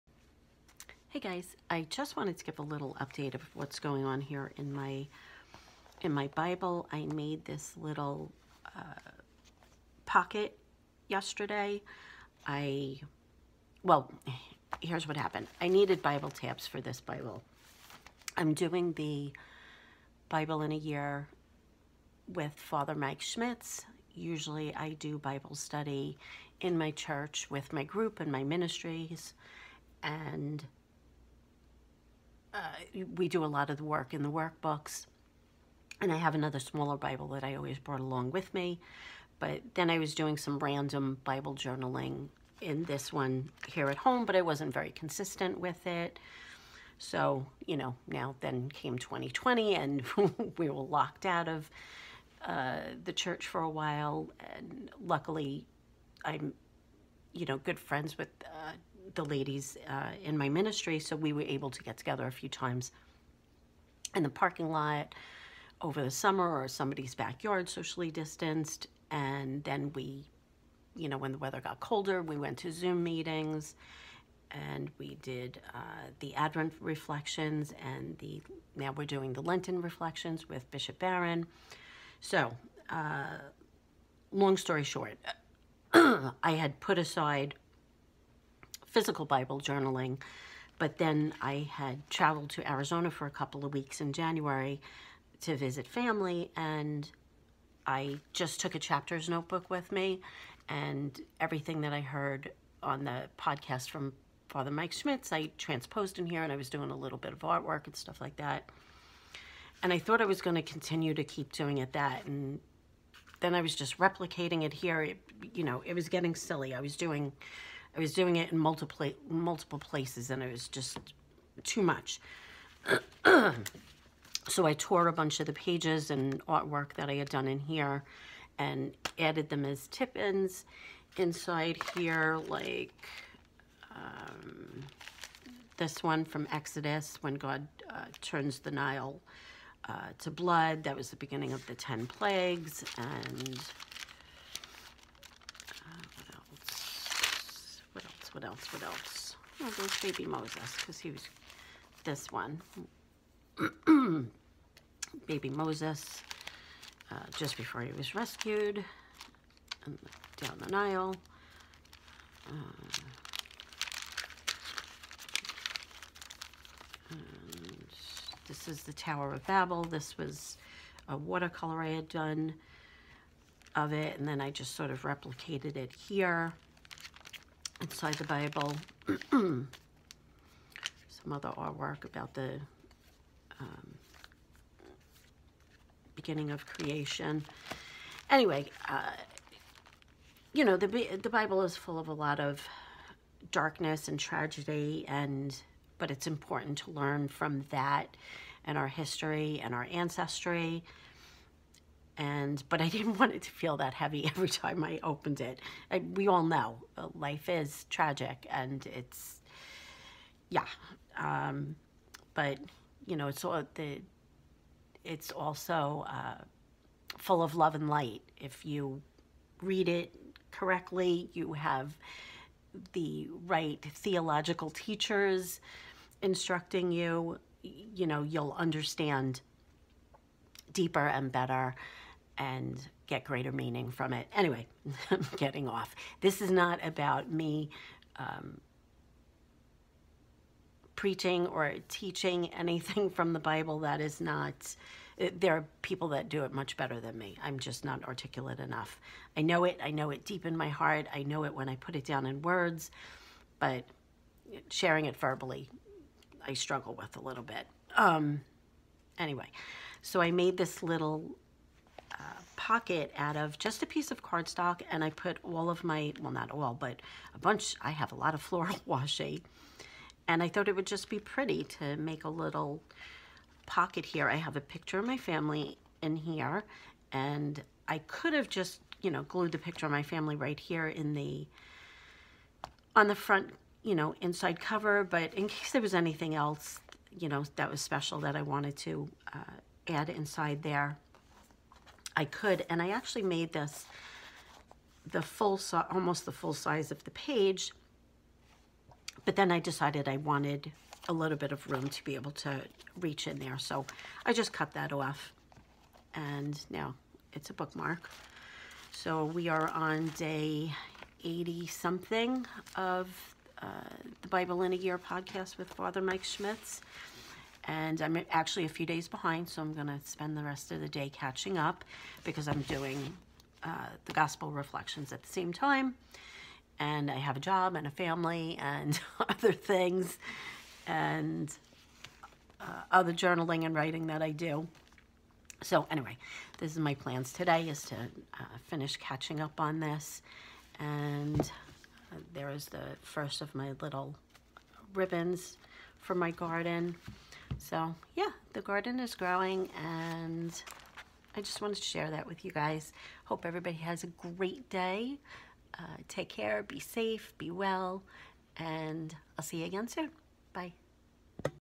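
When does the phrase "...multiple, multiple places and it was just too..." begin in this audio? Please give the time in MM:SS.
01:58.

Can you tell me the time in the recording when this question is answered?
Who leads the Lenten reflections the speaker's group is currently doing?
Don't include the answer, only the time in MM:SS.
01:20.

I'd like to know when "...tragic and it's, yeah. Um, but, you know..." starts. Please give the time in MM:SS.
03:27.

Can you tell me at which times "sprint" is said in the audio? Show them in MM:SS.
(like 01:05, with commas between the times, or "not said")
not said.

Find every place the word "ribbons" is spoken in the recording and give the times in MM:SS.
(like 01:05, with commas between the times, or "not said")
05:44.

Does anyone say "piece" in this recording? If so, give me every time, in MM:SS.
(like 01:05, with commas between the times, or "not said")
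04:23.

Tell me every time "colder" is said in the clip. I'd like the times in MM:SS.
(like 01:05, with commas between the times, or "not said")
01:11.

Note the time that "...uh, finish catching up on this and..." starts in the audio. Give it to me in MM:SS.
05:37.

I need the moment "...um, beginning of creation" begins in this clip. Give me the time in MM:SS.
03:03.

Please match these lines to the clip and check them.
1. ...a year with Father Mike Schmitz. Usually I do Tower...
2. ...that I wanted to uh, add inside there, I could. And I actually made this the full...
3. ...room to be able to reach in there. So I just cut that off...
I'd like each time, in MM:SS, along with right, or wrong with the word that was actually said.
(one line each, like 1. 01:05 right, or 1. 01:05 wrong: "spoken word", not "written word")
1. 00:20 wrong: "Bible", not "Tower"
2. 04:48 right
3. 05:01 right.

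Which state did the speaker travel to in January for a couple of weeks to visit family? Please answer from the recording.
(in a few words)
Arizona.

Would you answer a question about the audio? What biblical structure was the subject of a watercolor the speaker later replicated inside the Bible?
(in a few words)
Tower of Babel.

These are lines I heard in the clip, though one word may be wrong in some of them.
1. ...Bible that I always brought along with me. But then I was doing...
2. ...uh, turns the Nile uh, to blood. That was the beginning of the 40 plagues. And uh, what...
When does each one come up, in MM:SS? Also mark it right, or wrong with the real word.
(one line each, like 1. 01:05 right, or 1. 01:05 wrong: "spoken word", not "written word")
1. 00:36 right
2. 02:17 wrong: "10", not "40".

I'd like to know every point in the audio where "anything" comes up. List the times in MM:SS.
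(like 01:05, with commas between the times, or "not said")
04:02, 04:45.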